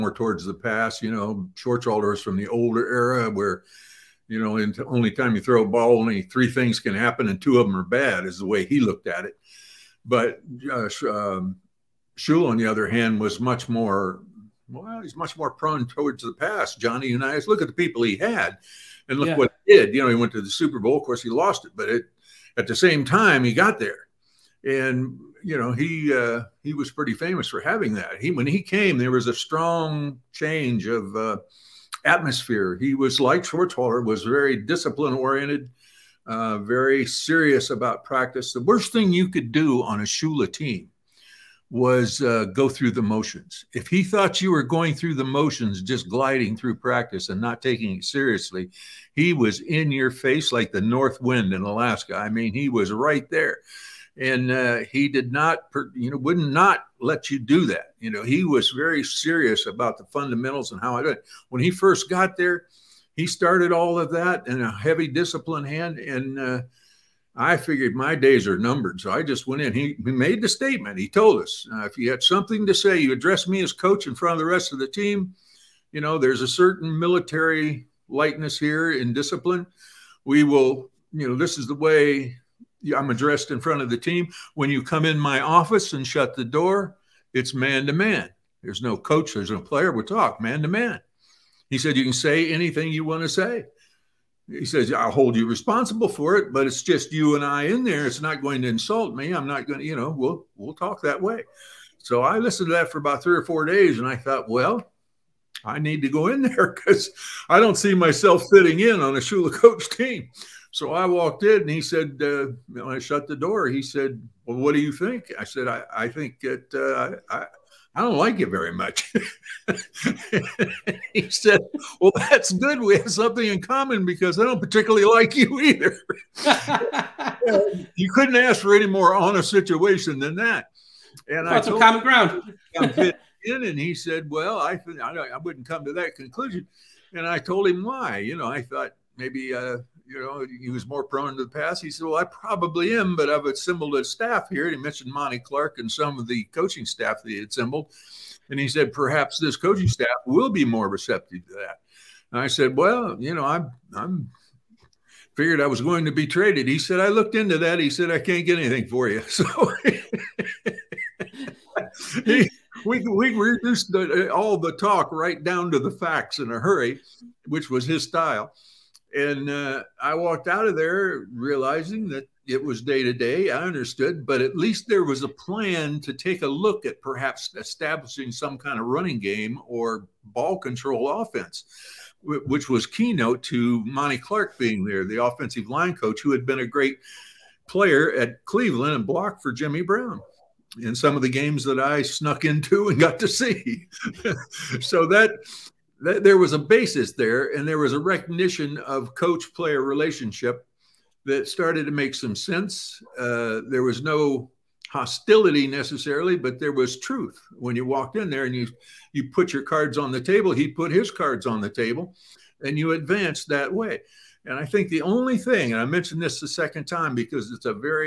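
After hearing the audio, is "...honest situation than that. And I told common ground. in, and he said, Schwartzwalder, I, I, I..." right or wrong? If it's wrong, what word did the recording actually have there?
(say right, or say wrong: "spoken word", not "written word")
wrong: "Well", not "Schwartzwalder".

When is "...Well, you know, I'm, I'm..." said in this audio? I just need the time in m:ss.
2:32.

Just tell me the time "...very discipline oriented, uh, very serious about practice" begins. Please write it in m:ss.
0:34.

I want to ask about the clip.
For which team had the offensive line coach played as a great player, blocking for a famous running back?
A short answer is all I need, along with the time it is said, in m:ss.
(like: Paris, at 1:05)
Cleveland, at 3:08.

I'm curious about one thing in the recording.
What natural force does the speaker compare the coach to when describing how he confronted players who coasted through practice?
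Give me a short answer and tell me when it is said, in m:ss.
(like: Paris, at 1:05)
the north wind in Alaska, at 0:50.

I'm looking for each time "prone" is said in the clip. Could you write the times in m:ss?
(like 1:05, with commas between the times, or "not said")
0:15, 2:21.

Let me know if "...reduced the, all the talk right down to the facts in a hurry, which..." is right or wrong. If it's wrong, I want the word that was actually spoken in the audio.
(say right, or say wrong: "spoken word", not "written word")
right.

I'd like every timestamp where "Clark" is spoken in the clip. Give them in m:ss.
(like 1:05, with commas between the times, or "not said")
2:25, 3:04.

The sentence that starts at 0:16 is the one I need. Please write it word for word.
Johnny Unitas, look at the people he had and look yeah.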